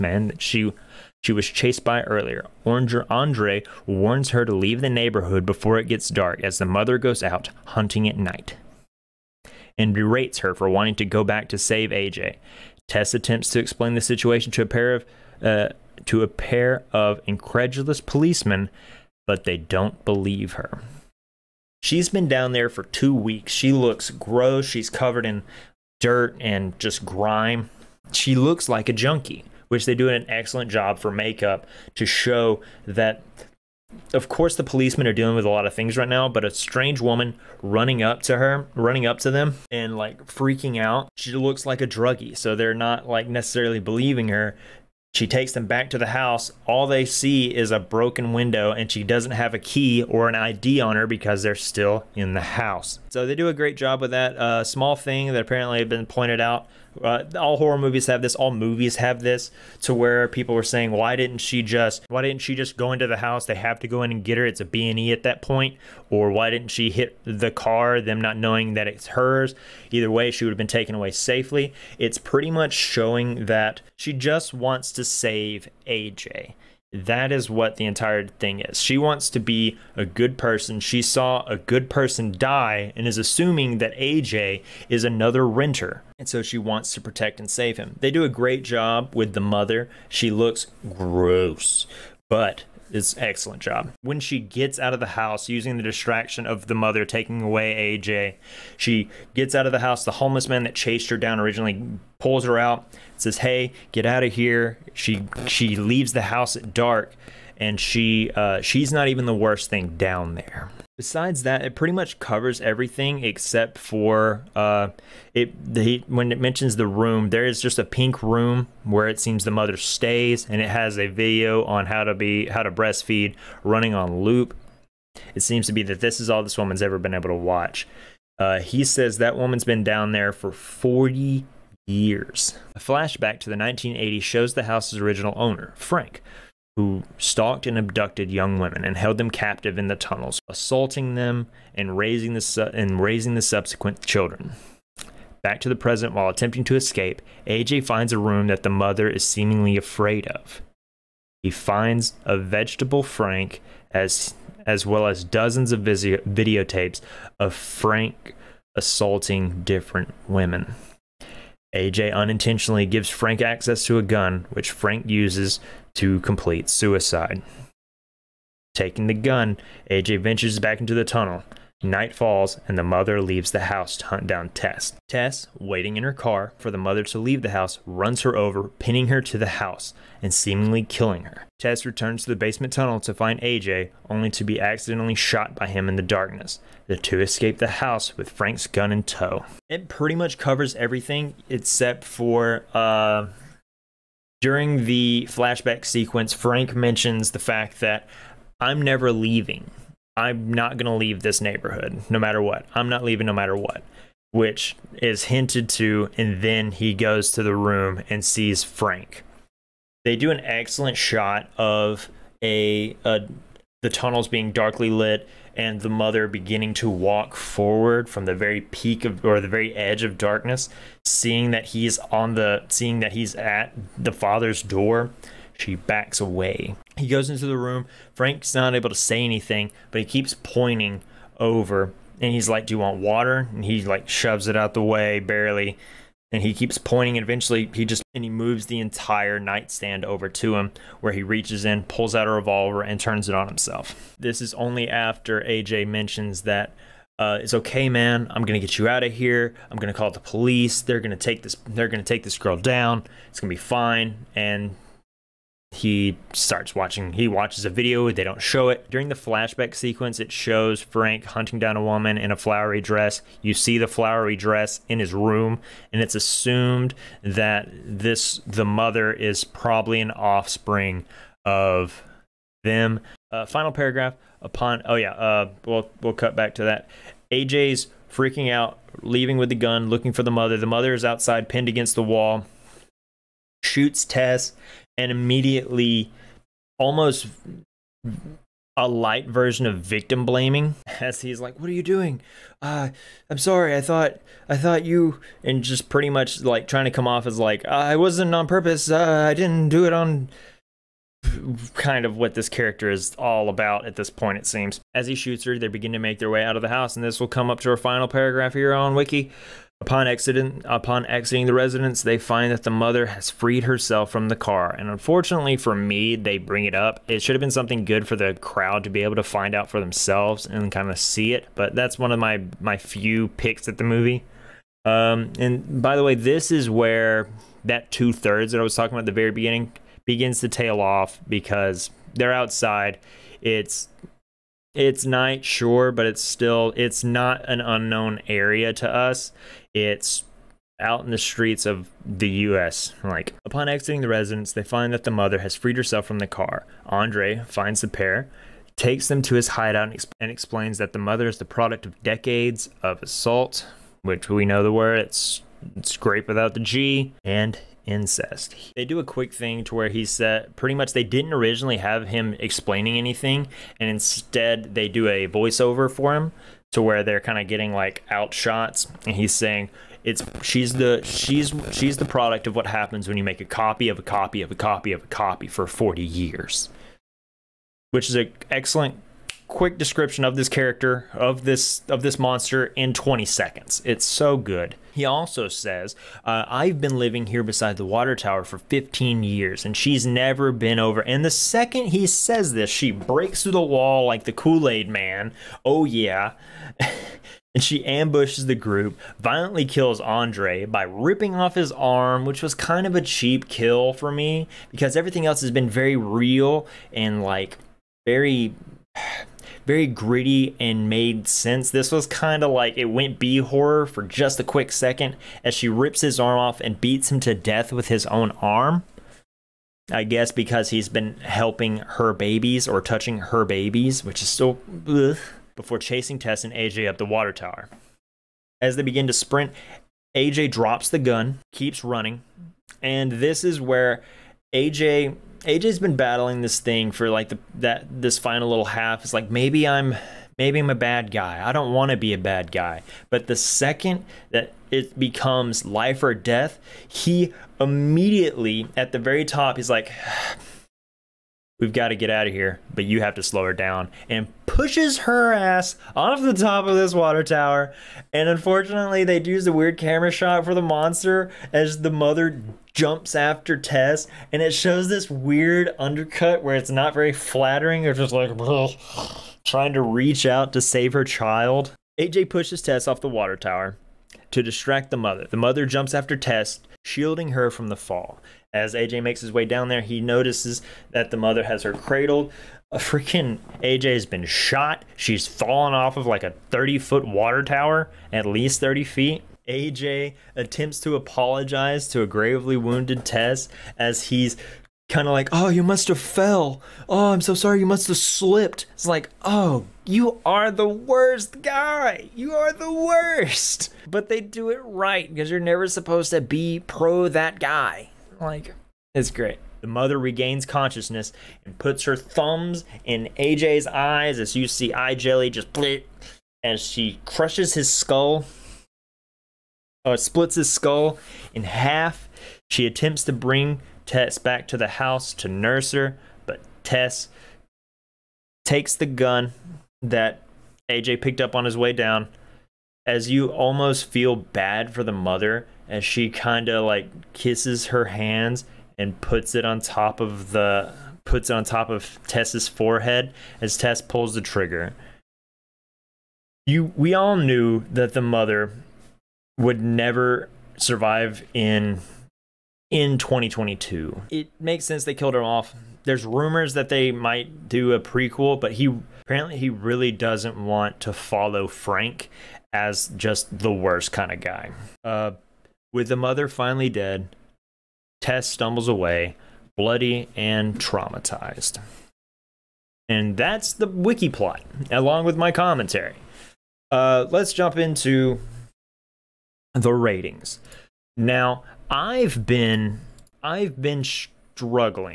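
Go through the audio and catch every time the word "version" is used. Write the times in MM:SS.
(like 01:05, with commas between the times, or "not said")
04:49.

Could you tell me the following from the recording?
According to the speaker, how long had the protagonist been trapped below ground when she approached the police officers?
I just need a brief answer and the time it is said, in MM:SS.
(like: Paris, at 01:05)
two weeks, at 00:22.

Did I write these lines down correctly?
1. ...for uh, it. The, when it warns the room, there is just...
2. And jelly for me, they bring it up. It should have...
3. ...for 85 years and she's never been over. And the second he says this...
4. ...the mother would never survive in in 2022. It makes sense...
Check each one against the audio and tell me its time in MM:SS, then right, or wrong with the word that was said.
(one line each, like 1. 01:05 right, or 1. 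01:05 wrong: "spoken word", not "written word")
1. 01:53 wrong: "mentions", not "warns"
2. 05:14 wrong: "unfortunately", not "jelly"
3. 06:28 wrong: "15", not "85"
4. 09:07 right.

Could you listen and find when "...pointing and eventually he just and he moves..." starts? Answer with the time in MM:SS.
03:56.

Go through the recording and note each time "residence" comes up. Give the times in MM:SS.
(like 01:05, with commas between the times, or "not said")
05:11, 05:44.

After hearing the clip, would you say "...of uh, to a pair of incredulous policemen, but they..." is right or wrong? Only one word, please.
right.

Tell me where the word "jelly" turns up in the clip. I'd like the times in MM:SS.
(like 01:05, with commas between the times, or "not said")
08:34.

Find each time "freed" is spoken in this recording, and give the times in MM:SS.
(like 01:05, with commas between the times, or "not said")
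05:13, 05:45.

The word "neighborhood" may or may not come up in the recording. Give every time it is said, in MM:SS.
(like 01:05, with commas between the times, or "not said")
00:04, 03:21.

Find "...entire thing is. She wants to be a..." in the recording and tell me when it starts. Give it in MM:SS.
01:17.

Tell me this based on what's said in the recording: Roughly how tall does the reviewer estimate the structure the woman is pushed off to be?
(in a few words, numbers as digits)
30 feet.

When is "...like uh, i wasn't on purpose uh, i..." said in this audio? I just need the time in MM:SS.
04:57.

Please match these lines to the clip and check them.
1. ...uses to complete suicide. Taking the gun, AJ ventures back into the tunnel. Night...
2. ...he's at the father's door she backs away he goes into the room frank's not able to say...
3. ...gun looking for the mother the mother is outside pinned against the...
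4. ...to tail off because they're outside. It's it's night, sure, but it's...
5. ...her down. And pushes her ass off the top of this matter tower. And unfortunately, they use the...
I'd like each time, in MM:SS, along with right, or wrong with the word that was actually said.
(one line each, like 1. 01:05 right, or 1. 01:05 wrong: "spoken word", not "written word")
1. 02:45 right
2. 03:43 right
3. 04:39 right
4. 05:30 right
5. 07:33 wrong: "water", not "matter".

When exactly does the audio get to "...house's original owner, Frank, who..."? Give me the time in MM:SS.
02:14.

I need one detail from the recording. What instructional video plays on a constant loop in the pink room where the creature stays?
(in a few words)
how to breastfeed.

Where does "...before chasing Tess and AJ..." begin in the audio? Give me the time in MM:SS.
07:05.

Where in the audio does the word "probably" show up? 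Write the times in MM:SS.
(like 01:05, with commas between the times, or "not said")
04:29.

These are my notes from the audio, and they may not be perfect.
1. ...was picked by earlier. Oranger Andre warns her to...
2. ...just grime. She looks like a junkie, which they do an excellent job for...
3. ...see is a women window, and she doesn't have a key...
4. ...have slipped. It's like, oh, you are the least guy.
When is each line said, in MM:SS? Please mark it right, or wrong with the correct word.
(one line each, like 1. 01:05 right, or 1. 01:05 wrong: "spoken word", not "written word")
1. 00:01 wrong: "chased", not "picked"
2. 00:26 right
3. 00:47 wrong: "broken", not "women"
4. 08:17 wrong: "worst", not "least".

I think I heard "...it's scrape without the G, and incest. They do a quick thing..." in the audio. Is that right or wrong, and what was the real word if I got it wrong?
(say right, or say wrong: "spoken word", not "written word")
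right.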